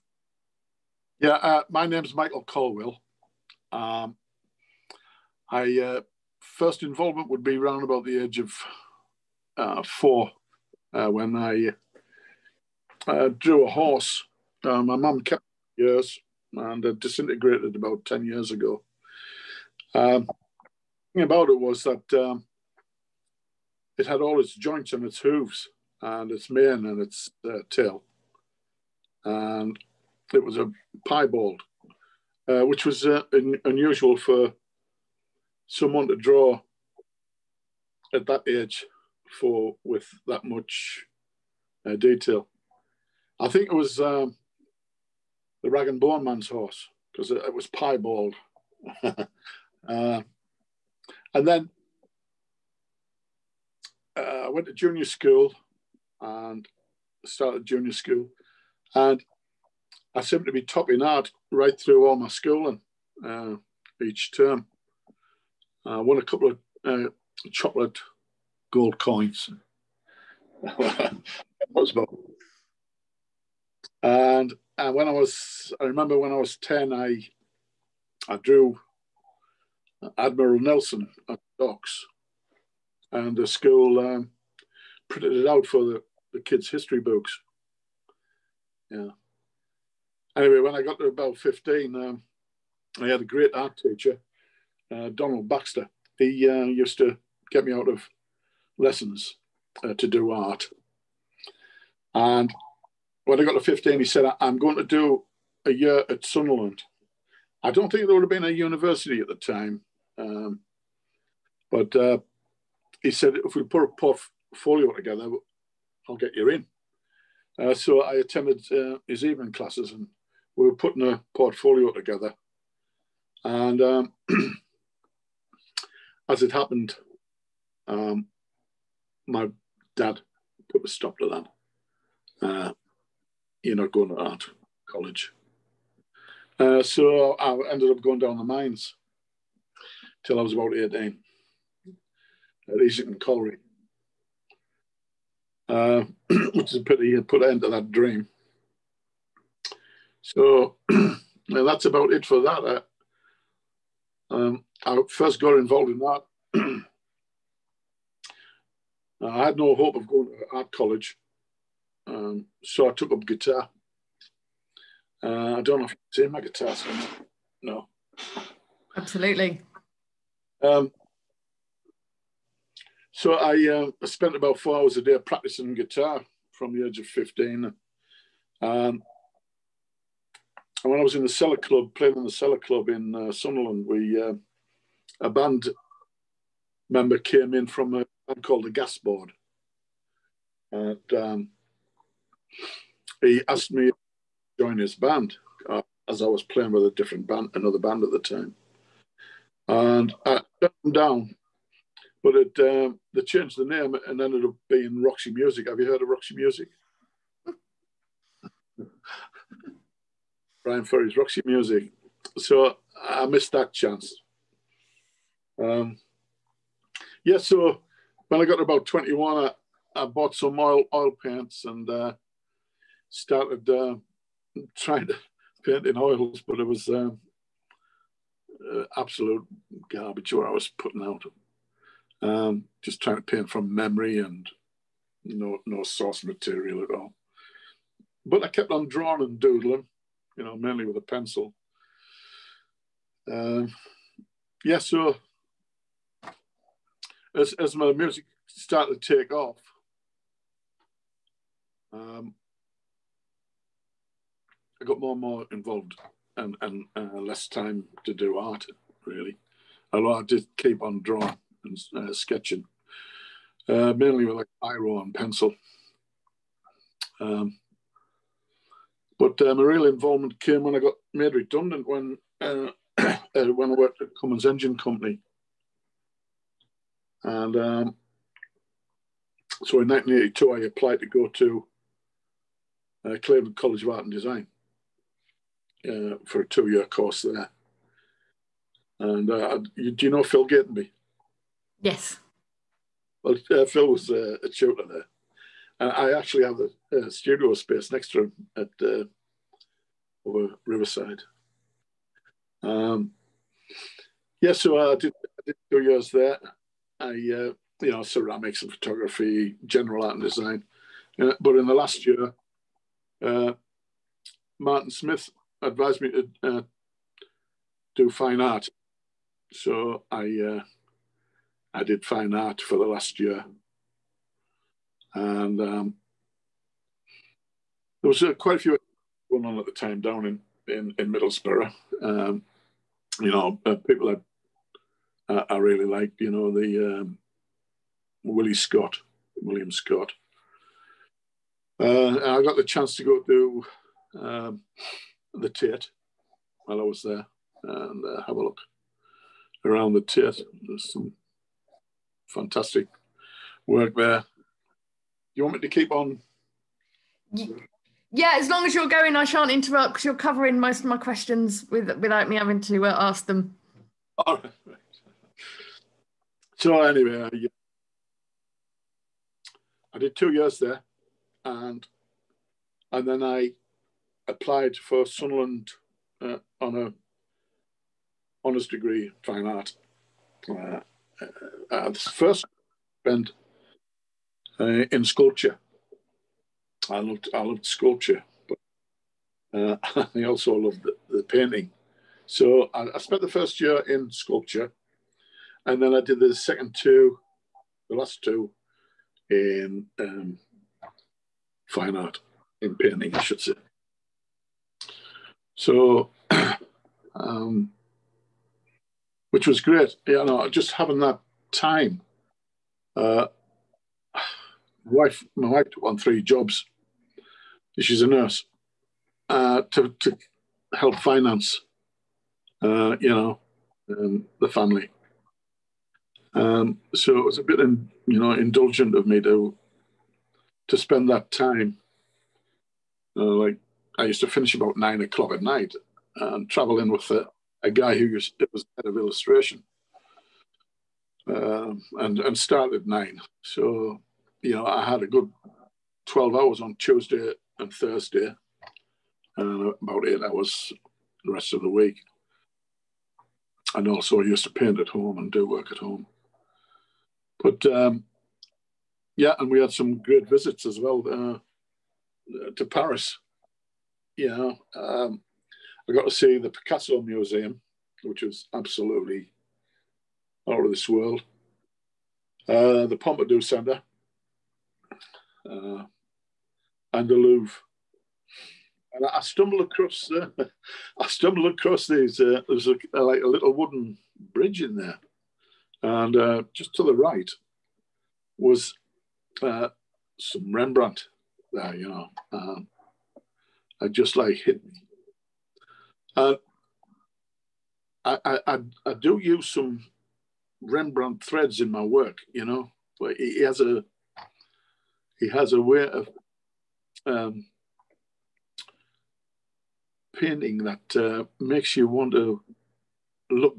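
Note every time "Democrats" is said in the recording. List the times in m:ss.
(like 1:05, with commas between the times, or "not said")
not said.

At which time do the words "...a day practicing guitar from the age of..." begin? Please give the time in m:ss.
2:54.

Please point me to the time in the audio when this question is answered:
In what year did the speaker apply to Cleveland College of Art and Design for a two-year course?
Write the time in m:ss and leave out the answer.
4:39.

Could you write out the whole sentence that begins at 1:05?
I won a couple of uh, chocolate gold coins.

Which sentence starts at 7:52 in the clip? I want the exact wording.
Uh, the Pompidou Centre, uh, and the Louvre.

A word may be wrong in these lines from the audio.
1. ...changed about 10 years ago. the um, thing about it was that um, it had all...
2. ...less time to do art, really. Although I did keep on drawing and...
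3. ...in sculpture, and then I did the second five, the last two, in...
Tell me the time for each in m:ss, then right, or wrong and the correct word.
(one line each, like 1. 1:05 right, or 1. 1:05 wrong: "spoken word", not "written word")
1. 0:16 wrong: "disintegrated", not "changed"
2. 4:17 right
3. 6:33 wrong: "two", not "five".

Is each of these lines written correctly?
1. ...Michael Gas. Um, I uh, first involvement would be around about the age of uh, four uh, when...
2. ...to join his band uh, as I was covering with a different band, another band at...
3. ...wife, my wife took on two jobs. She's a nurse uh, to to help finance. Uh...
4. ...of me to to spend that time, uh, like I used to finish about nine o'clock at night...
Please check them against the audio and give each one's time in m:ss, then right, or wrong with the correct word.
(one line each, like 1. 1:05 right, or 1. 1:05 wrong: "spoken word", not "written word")
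1. 0:02 wrong: "Colwill", not "Gas"
2. 3:13 wrong: "playing", not "covering"
3. 6:54 wrong: "three", not "two"
4. 7:08 right.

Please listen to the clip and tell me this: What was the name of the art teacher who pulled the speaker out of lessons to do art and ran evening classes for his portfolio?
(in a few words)
Donald Baxter.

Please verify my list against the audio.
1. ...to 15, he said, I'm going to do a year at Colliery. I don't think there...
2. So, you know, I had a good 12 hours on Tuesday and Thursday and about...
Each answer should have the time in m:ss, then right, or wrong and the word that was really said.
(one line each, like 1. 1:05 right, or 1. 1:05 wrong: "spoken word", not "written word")
1. 1:43 wrong: "Sunderland", not "Colliery"
2. 7:23 right.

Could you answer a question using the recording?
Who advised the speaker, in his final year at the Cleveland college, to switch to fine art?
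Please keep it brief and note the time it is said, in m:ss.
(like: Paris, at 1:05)
Martin Smith, at 5:14.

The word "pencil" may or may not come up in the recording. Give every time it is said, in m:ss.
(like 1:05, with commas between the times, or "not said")
4:01, 4:25.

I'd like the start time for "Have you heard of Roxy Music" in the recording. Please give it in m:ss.
3:25.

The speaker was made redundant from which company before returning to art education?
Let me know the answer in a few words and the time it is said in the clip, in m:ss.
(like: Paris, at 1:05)
Cummins Engine Company, at 4:34.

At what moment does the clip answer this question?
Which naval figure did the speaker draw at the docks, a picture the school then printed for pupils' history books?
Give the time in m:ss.
1:20.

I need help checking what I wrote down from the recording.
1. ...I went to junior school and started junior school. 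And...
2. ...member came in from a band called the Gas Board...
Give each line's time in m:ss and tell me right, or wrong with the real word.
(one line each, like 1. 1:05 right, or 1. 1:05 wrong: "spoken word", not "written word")
1. 0:54 right
2. 3:06 right.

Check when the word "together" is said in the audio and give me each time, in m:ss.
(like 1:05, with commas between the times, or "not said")
1:54, 2:01.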